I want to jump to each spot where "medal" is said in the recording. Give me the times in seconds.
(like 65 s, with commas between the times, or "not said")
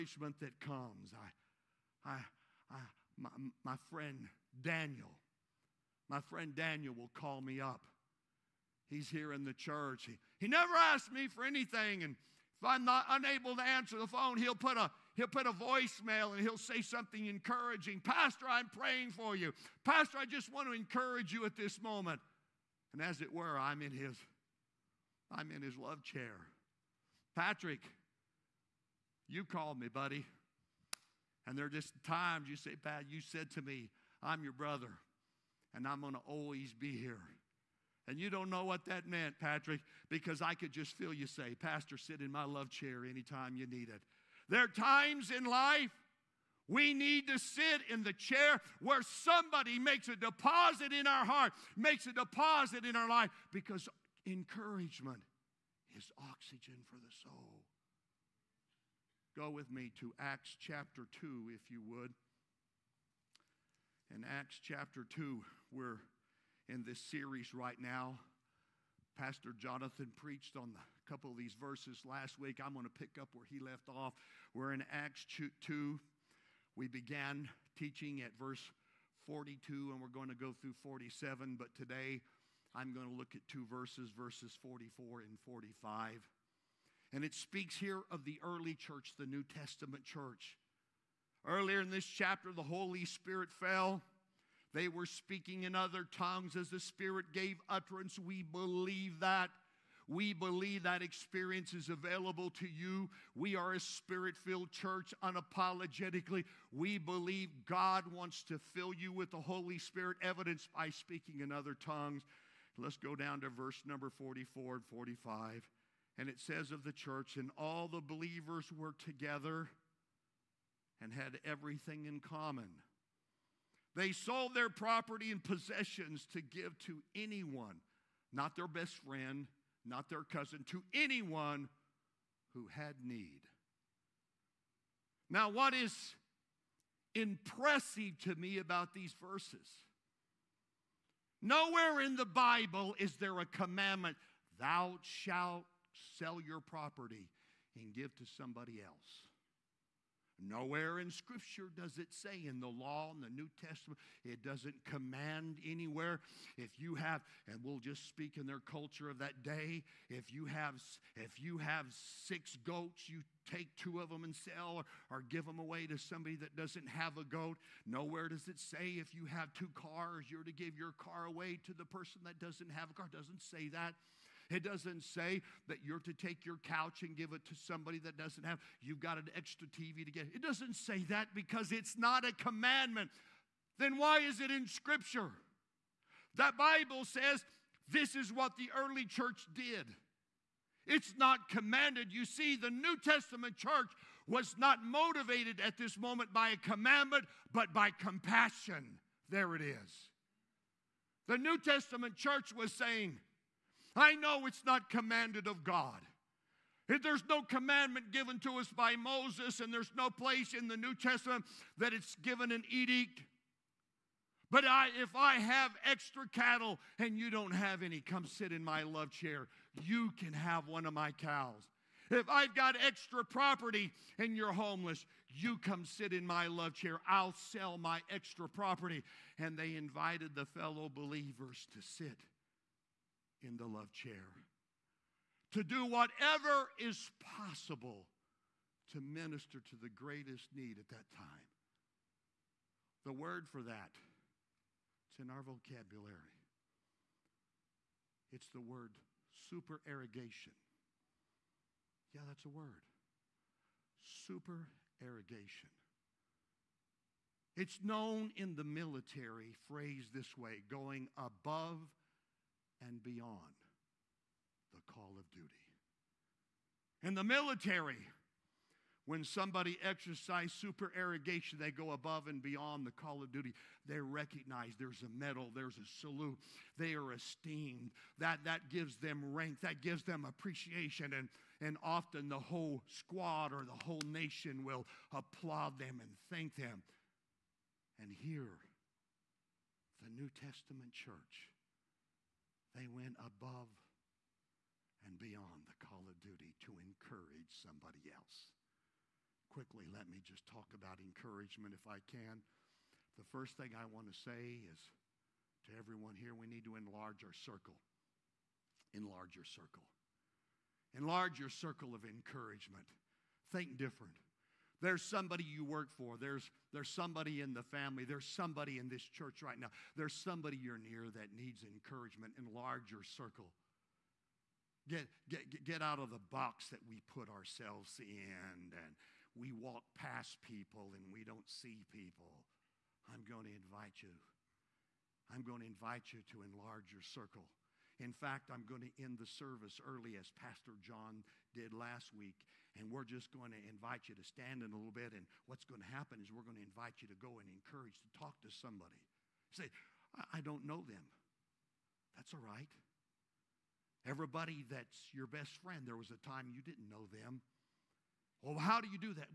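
275 s.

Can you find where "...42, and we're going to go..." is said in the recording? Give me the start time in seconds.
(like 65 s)
79 s.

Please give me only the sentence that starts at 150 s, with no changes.
Nowhere in Scripture does it say in the law, in the New Testament, it doesn't command anywhere.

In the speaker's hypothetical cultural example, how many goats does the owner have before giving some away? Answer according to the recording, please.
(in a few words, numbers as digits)
6.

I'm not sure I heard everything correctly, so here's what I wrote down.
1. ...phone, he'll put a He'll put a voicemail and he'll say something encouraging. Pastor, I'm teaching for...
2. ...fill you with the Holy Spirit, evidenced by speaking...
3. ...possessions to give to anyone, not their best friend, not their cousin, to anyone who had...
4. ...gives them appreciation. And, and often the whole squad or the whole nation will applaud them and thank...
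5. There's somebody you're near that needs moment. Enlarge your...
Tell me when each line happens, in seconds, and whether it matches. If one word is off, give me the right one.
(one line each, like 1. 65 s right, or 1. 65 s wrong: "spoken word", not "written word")
1. 14 s wrong: "praying", not "teaching"
2. 108 s right
3. 125 s right
4. 279 s right
5. 319 s wrong: "encouragement", not "moment".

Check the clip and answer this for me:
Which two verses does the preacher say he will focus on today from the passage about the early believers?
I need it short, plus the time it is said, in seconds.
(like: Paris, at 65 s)
44 and 45, at 84 s.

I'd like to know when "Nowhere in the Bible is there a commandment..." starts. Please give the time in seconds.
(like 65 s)
141 s.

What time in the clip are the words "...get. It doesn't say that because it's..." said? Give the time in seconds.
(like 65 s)
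180 s.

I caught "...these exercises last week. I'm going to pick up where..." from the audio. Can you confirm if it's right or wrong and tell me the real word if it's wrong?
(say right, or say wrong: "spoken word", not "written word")
wrong: "verses", not "exercises".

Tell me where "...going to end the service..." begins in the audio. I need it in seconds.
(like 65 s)
338 s.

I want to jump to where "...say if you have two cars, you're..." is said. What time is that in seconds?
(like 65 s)
168 s.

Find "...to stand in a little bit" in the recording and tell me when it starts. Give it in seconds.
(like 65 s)
344 s.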